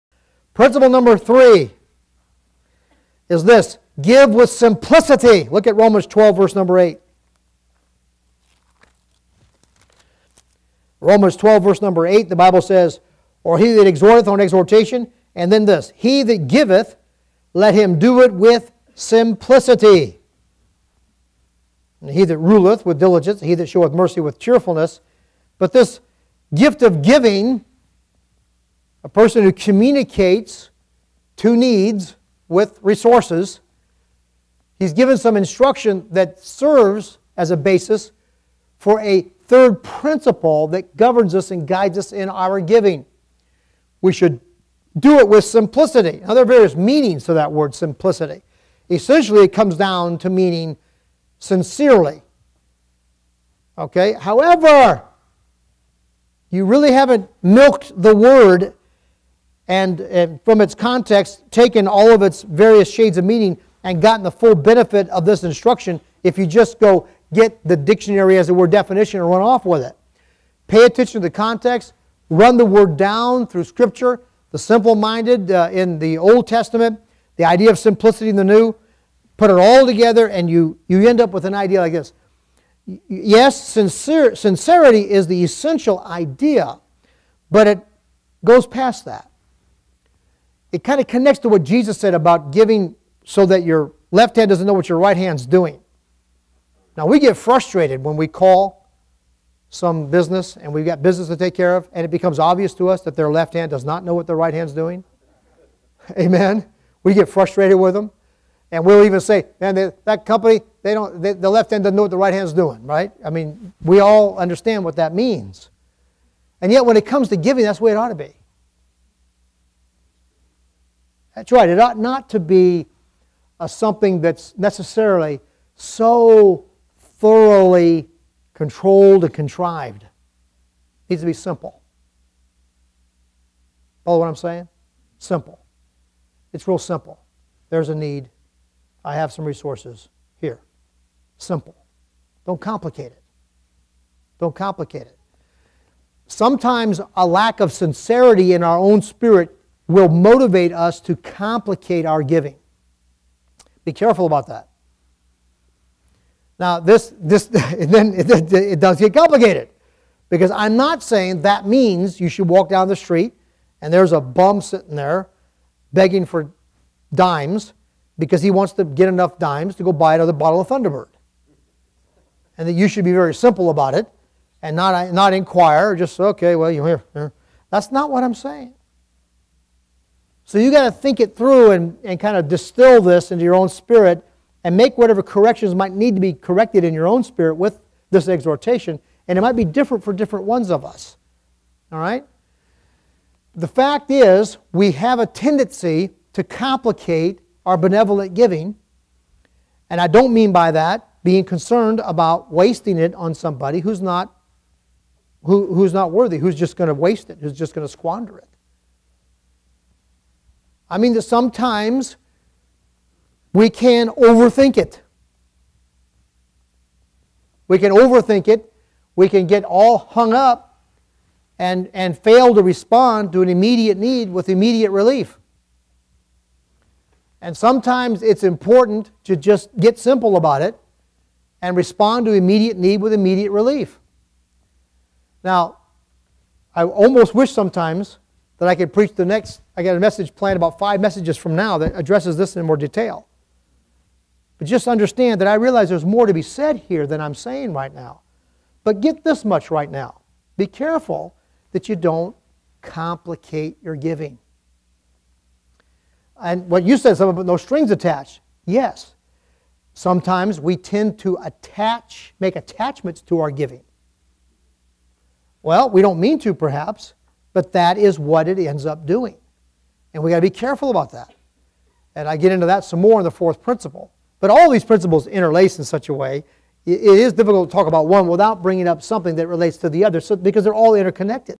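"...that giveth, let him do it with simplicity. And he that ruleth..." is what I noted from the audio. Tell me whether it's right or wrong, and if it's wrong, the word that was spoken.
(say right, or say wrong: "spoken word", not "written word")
right.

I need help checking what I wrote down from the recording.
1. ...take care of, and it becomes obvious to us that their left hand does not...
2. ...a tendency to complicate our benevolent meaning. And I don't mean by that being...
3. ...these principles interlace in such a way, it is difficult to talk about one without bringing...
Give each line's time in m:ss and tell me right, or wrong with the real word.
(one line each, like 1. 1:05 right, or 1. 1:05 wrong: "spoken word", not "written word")
1. 1:41 right
2. 3:15 wrong: "giving", not "meaning"
3. 4:34 right.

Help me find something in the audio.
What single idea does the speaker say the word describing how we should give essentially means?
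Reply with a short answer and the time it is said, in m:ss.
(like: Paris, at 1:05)
Sincerely, at 0:51.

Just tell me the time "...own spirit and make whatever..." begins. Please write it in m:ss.
3:03.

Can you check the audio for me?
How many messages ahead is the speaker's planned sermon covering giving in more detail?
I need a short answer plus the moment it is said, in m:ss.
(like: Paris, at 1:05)
5, at 4:00.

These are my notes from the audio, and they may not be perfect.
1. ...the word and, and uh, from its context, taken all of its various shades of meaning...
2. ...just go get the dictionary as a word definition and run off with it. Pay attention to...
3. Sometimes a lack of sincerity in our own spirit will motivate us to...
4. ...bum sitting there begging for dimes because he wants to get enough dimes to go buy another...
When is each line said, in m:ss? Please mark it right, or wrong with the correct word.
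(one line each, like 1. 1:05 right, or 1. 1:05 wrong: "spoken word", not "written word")
1. 0:58 right
2. 1:06 right
3. 2:26 right
4. 2:44 right.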